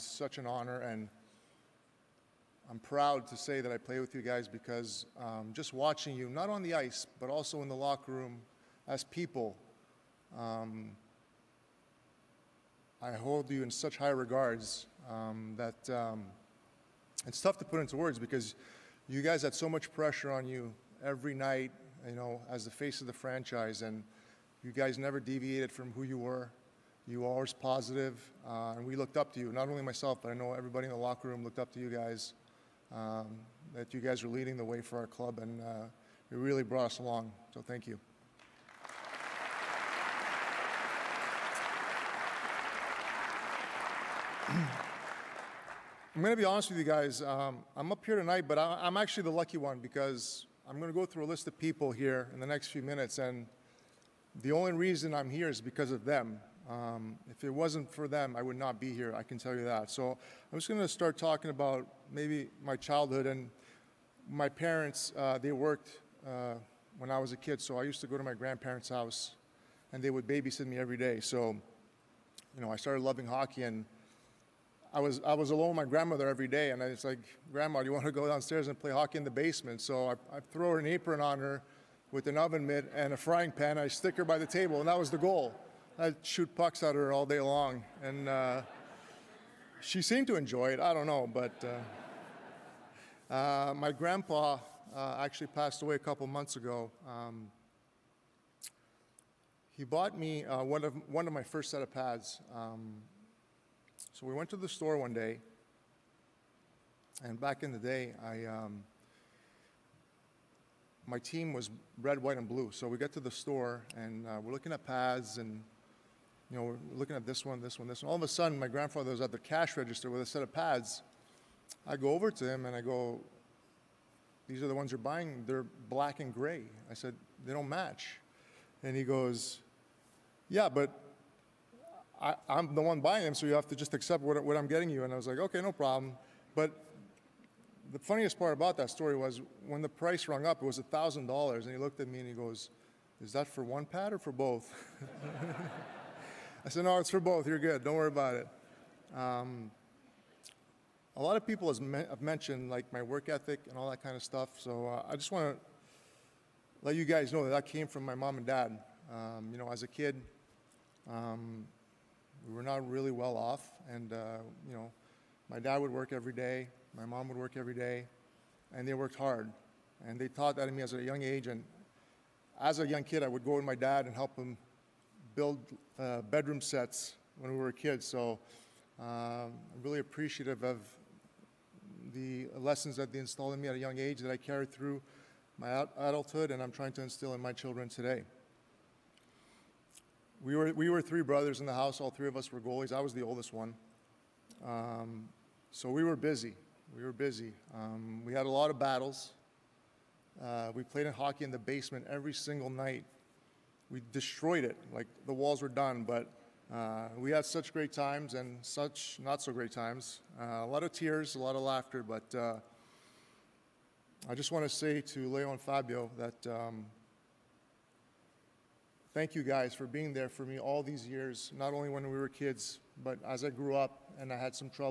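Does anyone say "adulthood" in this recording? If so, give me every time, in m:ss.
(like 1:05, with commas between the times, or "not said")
3:05.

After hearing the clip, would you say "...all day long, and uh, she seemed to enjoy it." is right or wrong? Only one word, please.
right.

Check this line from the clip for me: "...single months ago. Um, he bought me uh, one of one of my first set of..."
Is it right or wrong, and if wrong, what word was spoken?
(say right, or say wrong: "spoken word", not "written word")
wrong: "couple", not "single".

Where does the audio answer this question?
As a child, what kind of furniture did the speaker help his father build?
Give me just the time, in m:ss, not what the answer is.
2:56.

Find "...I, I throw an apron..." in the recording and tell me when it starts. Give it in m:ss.
1:20.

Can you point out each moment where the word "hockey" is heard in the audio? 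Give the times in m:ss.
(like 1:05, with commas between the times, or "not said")
1:13, 1:18, 3:21.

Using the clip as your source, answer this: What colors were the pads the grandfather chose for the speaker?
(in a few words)
black and gray.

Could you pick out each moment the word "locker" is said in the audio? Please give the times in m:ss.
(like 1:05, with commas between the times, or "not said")
0:07, 0:30.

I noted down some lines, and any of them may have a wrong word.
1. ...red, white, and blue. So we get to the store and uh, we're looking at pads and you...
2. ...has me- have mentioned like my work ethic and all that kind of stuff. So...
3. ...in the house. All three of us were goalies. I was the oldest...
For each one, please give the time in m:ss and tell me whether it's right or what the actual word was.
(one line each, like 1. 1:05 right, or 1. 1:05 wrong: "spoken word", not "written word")
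1. 1:51 right
2. 2:31 right
3. 3:11 right.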